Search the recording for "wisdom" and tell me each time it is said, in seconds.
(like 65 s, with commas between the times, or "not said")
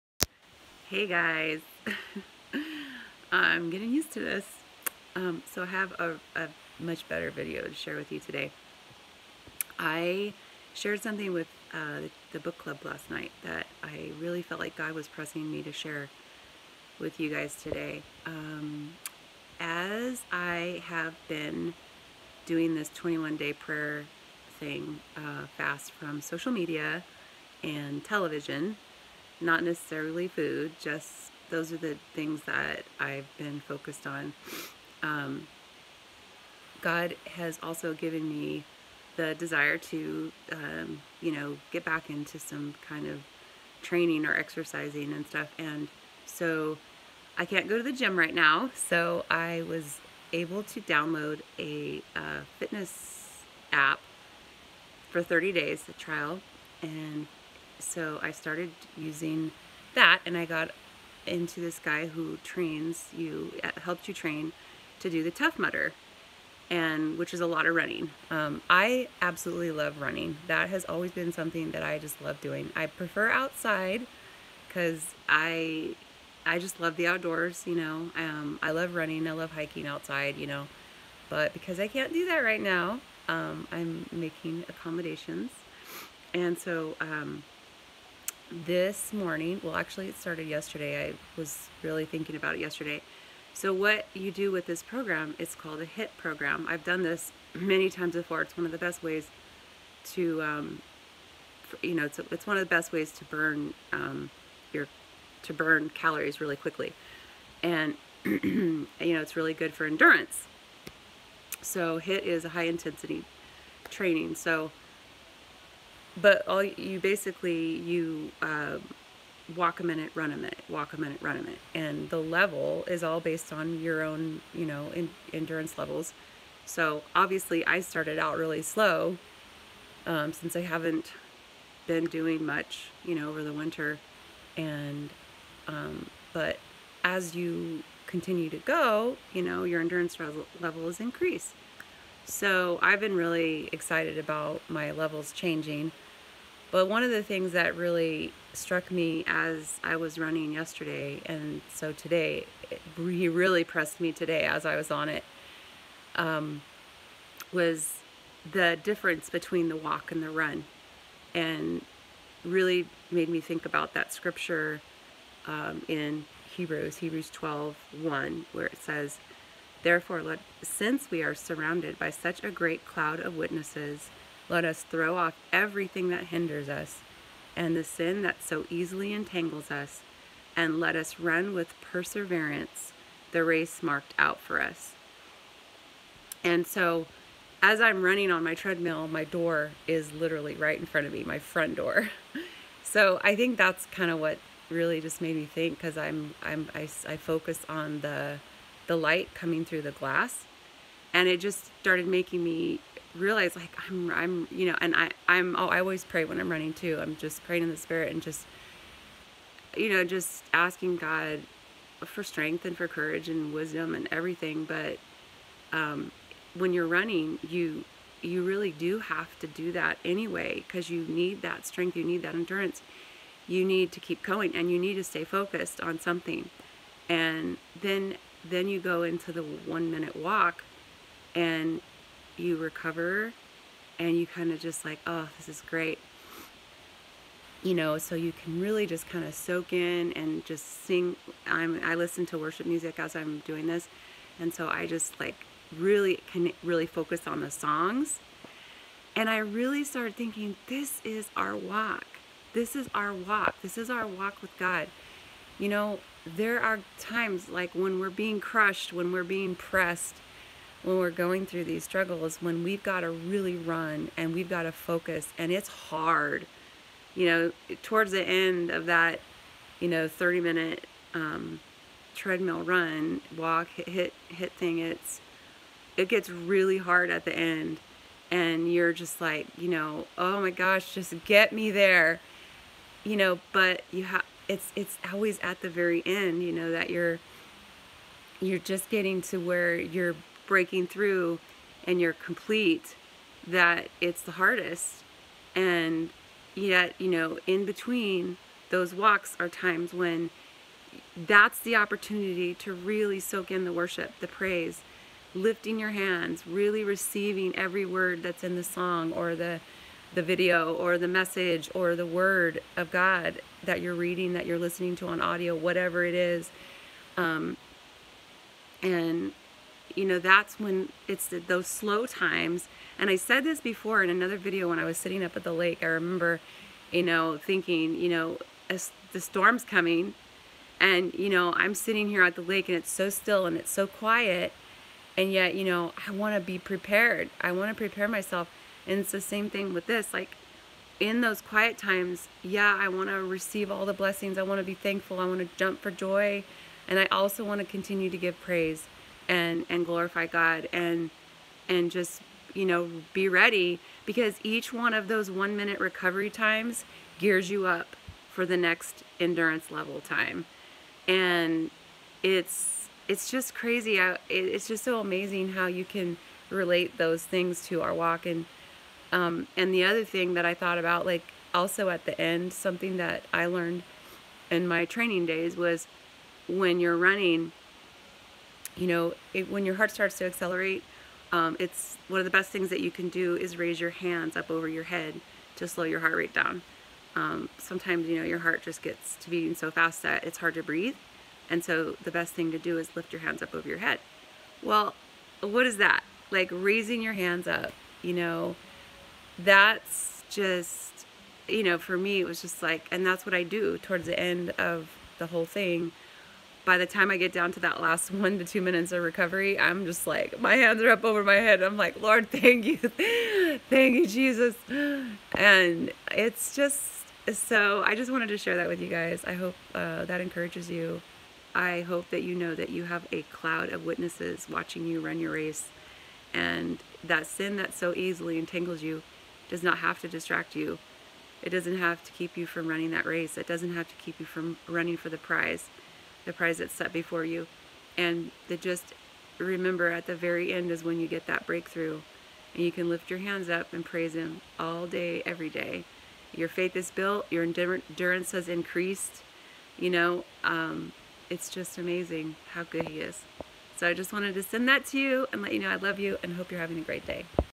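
213 s.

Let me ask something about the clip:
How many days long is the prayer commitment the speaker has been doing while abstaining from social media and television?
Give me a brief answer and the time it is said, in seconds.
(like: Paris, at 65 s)
21, at 22 s.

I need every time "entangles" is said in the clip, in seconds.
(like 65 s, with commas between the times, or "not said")
179 s, 428 s.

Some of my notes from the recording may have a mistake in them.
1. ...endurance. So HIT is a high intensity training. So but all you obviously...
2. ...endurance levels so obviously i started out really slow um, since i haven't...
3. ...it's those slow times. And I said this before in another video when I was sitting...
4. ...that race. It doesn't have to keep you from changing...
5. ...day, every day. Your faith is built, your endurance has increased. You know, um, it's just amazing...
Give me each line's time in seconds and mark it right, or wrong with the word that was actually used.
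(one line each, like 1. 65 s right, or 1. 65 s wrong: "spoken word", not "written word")
1. 109 s wrong: "basically", not "obviously"
2. 125 s right
3. 321 s right
4. 432 s wrong: "running", not "changing"
5. 444 s right.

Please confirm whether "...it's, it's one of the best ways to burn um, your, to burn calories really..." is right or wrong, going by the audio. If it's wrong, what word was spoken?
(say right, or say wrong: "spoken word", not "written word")
right.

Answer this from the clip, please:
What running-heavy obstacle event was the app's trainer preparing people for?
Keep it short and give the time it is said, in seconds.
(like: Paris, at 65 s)
Tough Mudder, at 65 s.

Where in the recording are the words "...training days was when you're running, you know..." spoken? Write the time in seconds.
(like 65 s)
374 s.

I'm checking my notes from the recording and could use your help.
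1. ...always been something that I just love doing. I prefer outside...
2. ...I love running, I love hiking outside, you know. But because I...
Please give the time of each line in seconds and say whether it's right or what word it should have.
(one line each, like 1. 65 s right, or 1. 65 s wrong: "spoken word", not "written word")
1. 70 s right
2. 78 s right.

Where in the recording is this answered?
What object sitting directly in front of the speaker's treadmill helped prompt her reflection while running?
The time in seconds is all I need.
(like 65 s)
191 s.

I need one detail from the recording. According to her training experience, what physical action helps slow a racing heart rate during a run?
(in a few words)
raise your hands.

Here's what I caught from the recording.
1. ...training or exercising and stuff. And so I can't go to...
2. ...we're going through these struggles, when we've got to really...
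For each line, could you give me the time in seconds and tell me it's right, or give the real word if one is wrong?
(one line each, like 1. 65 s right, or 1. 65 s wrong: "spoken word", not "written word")
1. 43 s right
2. 260 s right.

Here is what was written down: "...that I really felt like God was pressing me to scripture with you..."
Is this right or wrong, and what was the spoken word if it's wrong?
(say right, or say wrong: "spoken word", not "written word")
wrong: "share", not "scripture".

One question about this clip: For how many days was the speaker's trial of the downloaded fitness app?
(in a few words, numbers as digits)
30.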